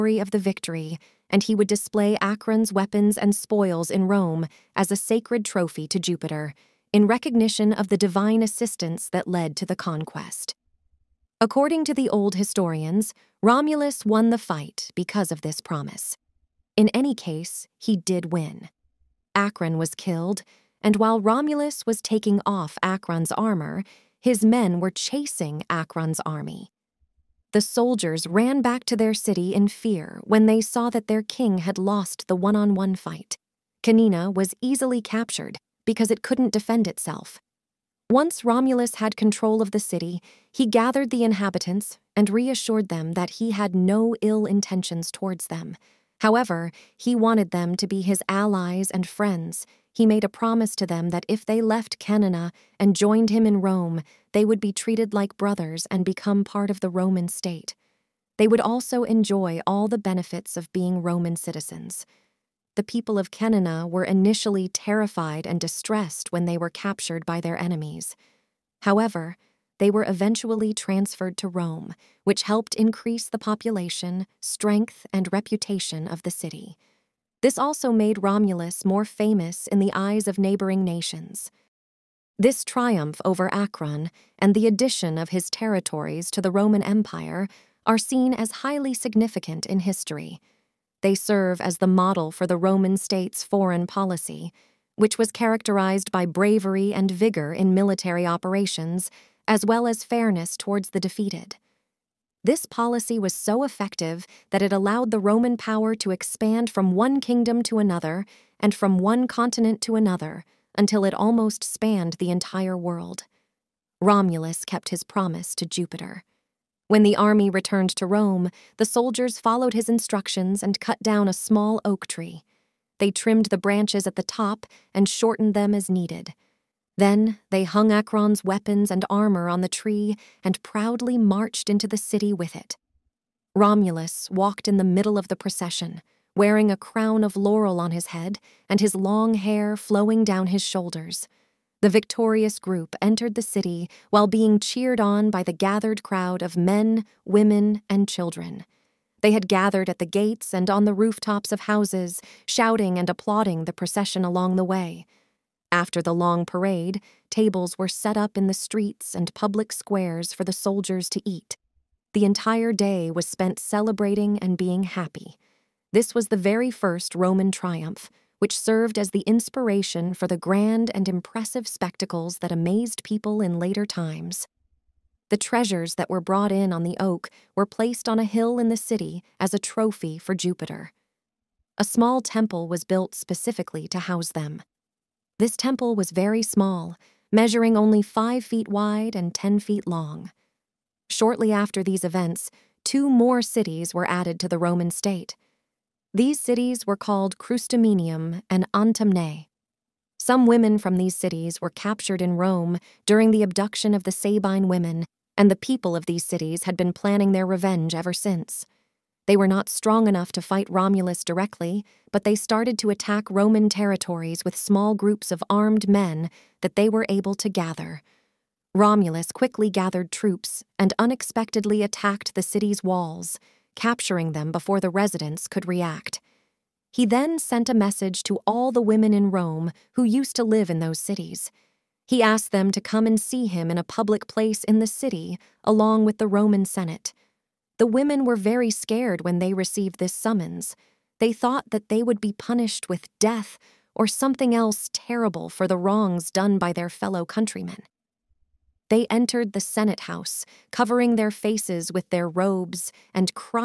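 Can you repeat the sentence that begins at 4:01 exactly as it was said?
They thought that they would be punished with death or something else terrible for the wrongs done by their fellow countrymen.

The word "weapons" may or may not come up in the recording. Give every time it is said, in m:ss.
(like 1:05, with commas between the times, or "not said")
0:02, 2:08.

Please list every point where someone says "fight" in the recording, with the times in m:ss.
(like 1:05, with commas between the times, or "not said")
0:14, 0:32, 3:30.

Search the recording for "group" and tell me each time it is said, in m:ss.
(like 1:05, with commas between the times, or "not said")
2:22, 3:34.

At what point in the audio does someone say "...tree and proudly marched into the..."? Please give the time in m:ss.
2:09.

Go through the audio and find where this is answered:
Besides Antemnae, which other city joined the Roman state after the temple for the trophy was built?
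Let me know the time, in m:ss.
3:17.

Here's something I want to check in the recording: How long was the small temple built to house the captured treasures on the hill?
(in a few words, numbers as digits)
10 feet.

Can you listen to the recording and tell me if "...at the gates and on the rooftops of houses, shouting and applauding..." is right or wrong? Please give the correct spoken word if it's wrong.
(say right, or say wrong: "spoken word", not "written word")
right.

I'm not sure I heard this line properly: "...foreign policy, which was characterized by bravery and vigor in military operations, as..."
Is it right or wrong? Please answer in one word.
right.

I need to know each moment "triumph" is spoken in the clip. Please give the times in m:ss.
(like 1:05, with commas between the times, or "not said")
1:22, 2:47.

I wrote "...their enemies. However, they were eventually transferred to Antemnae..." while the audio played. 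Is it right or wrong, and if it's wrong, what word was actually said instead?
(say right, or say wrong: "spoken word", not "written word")
wrong: "Rome", not "Antemnae".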